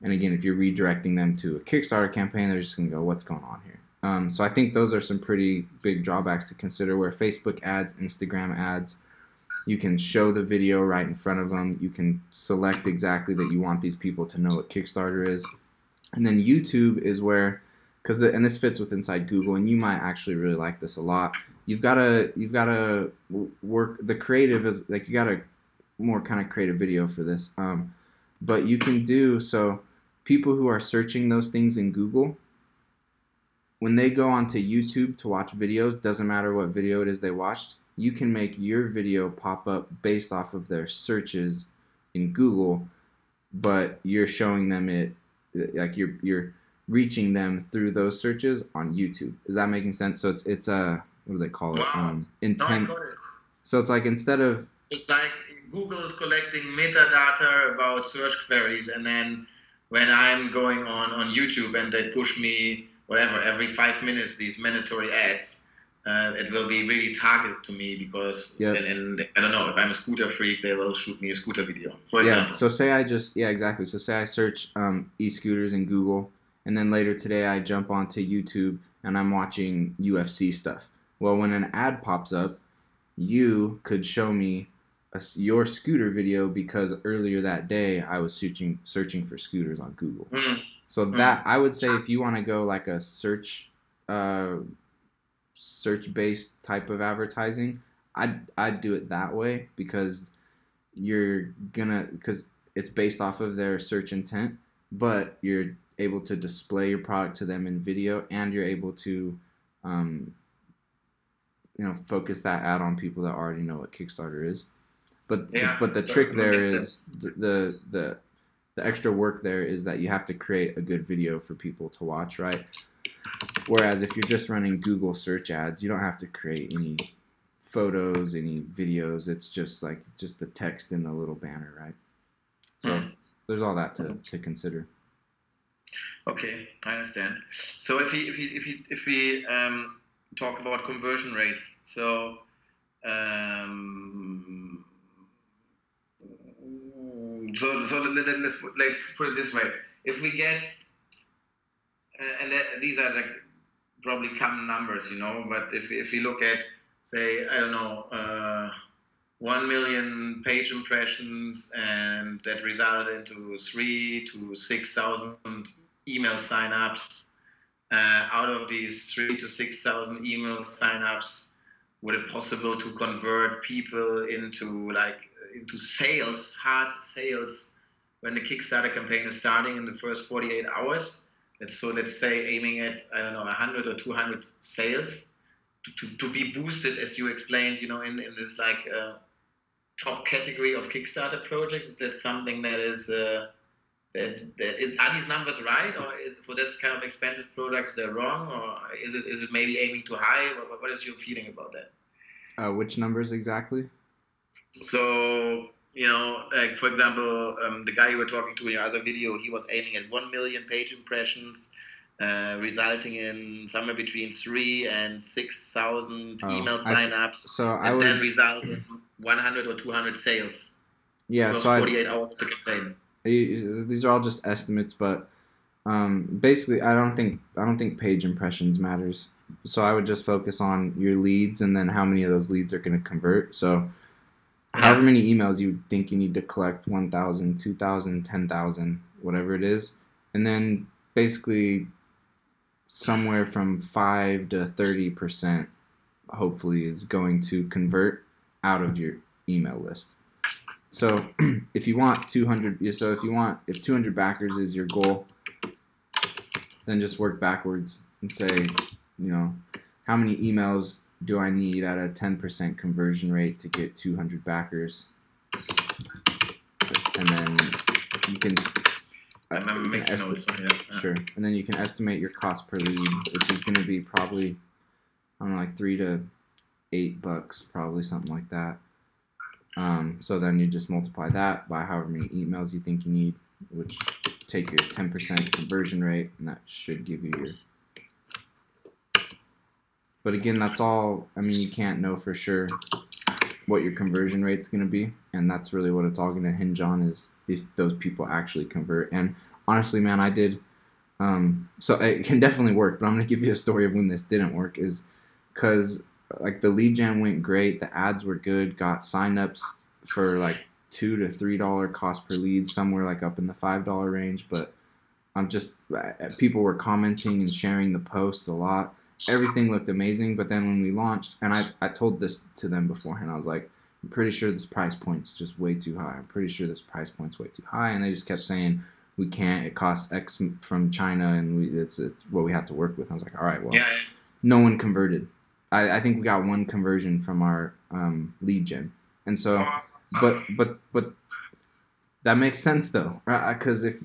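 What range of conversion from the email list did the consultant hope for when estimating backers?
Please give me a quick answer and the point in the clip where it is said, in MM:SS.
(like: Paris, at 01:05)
5 to 30%, at 04:03.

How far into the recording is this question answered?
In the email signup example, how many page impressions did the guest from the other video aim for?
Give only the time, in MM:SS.
02:39.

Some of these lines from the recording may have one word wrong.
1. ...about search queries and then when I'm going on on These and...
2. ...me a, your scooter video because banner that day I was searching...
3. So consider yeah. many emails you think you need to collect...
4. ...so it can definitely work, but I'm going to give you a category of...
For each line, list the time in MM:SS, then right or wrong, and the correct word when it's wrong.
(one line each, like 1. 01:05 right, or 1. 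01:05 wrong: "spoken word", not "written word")
1. 00:57 wrong: "YouTube", not "These"
2. 01:24 wrong: "earlier", not "banner"
3. 03:53 wrong: "however", not "consider"
4. 05:01 wrong: "story", not "category".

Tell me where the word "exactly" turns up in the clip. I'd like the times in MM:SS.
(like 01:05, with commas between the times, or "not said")
00:12, 01:13, 03:23.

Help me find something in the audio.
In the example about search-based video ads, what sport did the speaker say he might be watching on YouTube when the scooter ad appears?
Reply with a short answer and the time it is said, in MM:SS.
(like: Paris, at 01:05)
UFC, at 01:20.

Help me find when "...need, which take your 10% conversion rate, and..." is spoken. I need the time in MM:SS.
04:43.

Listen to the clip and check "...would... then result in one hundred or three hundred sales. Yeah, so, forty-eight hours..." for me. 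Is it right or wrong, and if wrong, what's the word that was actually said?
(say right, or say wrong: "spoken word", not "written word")
wrong: "two", not "three".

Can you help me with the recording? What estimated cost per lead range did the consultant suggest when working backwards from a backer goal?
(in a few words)
$3 to $8.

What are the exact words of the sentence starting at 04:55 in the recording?
And that's really what it's all going to hinge on is if those people actually convert.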